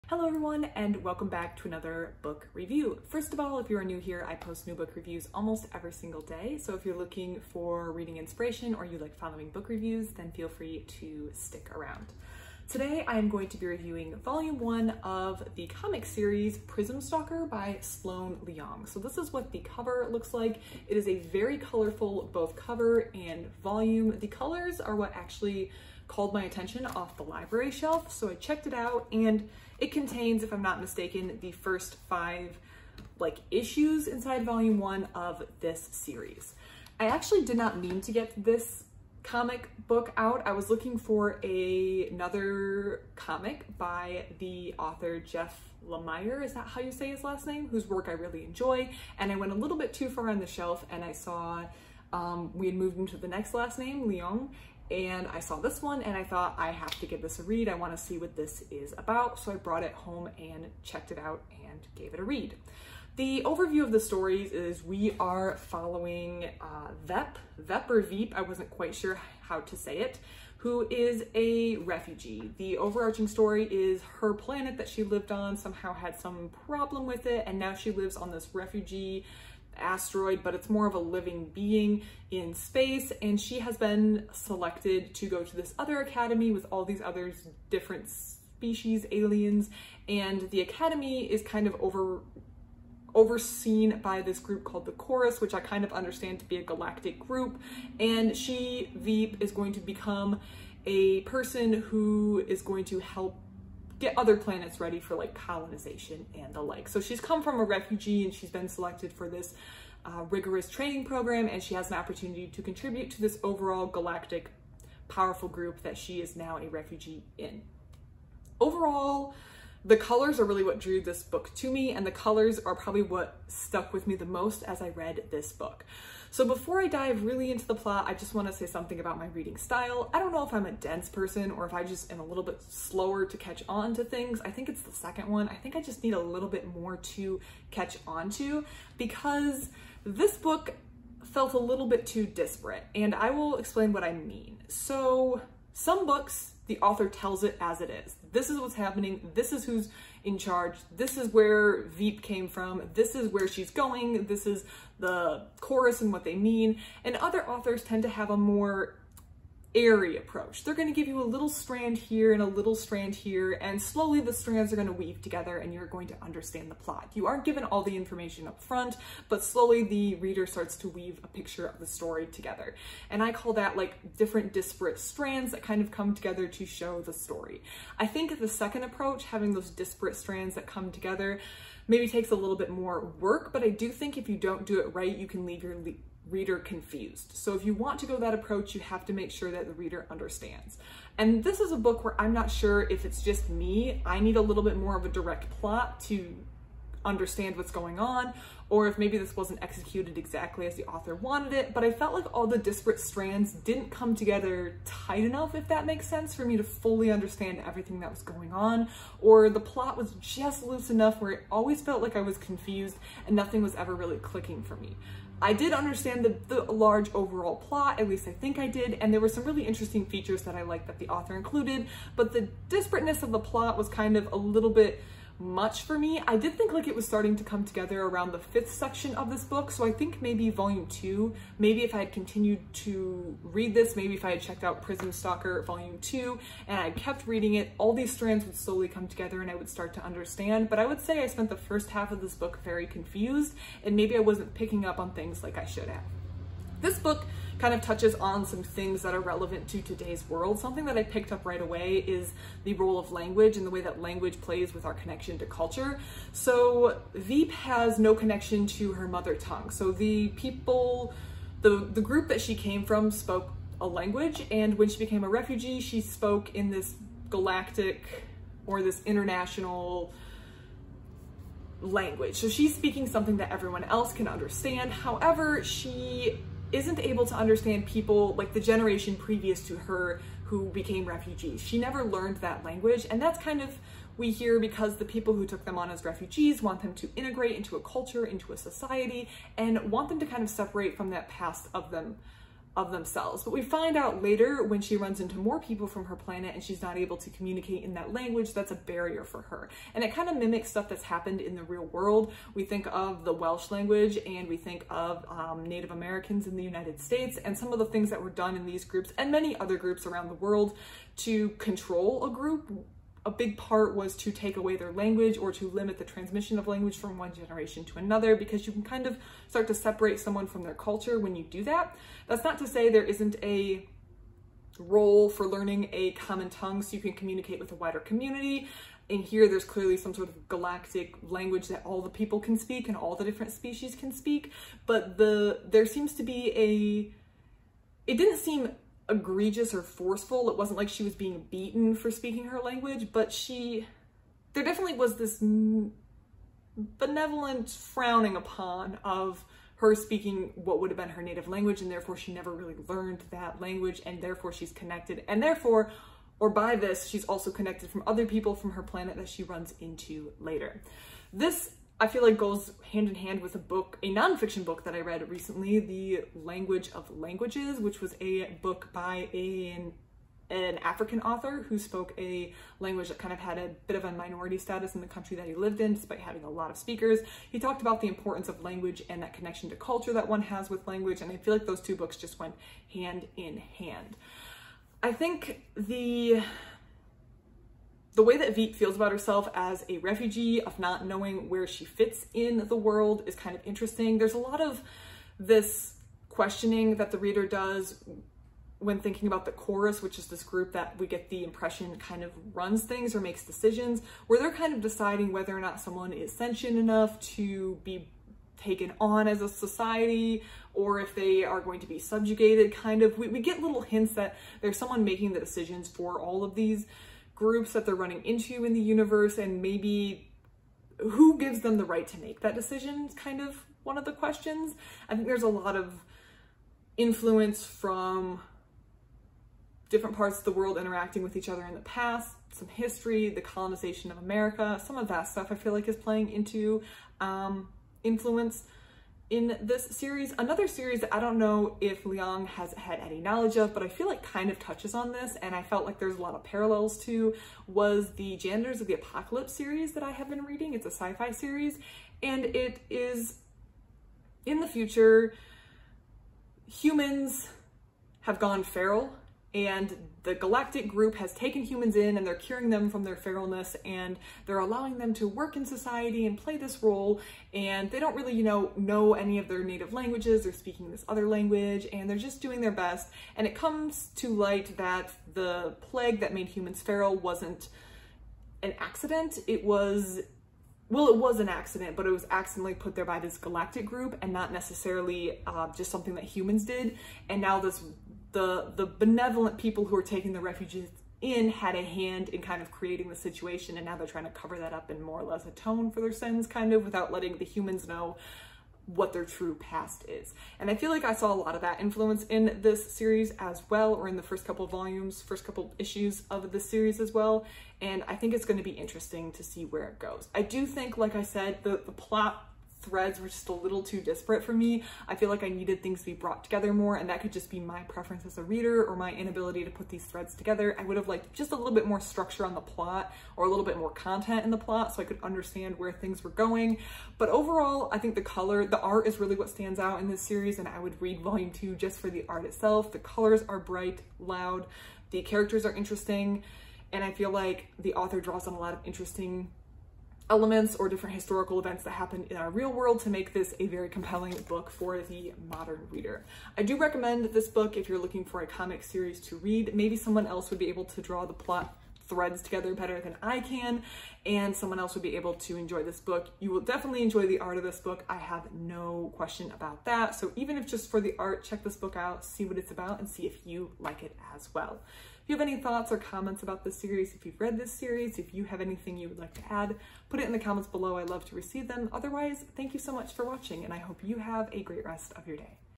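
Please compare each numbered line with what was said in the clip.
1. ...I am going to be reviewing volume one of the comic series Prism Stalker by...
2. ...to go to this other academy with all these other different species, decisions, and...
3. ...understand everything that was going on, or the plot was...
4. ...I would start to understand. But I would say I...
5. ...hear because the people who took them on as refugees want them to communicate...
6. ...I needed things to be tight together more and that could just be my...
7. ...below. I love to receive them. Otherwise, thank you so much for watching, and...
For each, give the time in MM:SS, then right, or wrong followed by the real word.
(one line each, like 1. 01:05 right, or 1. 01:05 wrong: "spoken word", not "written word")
1. 00:13 right
2. 01:25 wrong: "aliens", not "decisions"
3. 03:27 right
4. 03:59 right
5. 04:44 wrong: "integrate", not "communicate"
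6. 08:35 wrong: "brought", not "tight"
7. 09:30 right.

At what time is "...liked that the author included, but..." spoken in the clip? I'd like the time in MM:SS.
03:40.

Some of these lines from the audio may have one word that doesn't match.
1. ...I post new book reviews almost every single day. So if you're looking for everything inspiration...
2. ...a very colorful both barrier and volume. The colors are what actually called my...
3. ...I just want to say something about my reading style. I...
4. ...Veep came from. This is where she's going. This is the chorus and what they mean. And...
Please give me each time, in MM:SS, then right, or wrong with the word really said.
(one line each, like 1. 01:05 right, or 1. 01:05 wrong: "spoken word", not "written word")
1. 00:04 wrong: "reading", not "everything"
2. 00:21 wrong: "cover", not "barrier"
3. 02:08 right
4. 02:31 right.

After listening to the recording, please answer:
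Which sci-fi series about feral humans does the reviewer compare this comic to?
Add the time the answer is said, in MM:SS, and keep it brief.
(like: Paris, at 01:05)
Janitors of the Apocalypse, at 07:28.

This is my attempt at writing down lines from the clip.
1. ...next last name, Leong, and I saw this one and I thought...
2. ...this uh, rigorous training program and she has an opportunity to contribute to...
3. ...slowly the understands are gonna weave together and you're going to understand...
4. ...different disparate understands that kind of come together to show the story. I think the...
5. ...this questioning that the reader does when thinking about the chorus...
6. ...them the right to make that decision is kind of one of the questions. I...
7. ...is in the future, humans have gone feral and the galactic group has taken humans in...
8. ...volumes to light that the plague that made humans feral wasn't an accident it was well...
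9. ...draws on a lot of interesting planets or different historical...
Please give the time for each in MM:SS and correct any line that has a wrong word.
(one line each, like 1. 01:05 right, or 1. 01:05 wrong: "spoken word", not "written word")
1. 00:53 right
2. 01:49 right
3. 02:43 wrong: "strands", not "understands"
4. 02:54 wrong: "strands", not "understands"
5. 06:35 right
6. 07:01 right
7. 07:32 right
8. 07:53 wrong: "comes", not "volumes"
9. 08:58 wrong: "elements", not "planets".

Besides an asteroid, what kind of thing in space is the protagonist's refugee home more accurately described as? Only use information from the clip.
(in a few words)
a living being.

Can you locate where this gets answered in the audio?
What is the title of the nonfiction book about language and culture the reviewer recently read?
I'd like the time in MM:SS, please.
06:05.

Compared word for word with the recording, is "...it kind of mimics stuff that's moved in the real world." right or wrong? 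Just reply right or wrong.
wrong.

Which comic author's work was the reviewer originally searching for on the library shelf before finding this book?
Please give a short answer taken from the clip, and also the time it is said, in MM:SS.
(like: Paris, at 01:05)
Jeff Lemire, at 00:45.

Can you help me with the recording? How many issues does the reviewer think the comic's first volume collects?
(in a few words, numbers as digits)
5.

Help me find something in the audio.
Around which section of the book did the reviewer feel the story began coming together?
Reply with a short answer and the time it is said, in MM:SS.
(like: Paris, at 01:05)
the fifth, at 03:48.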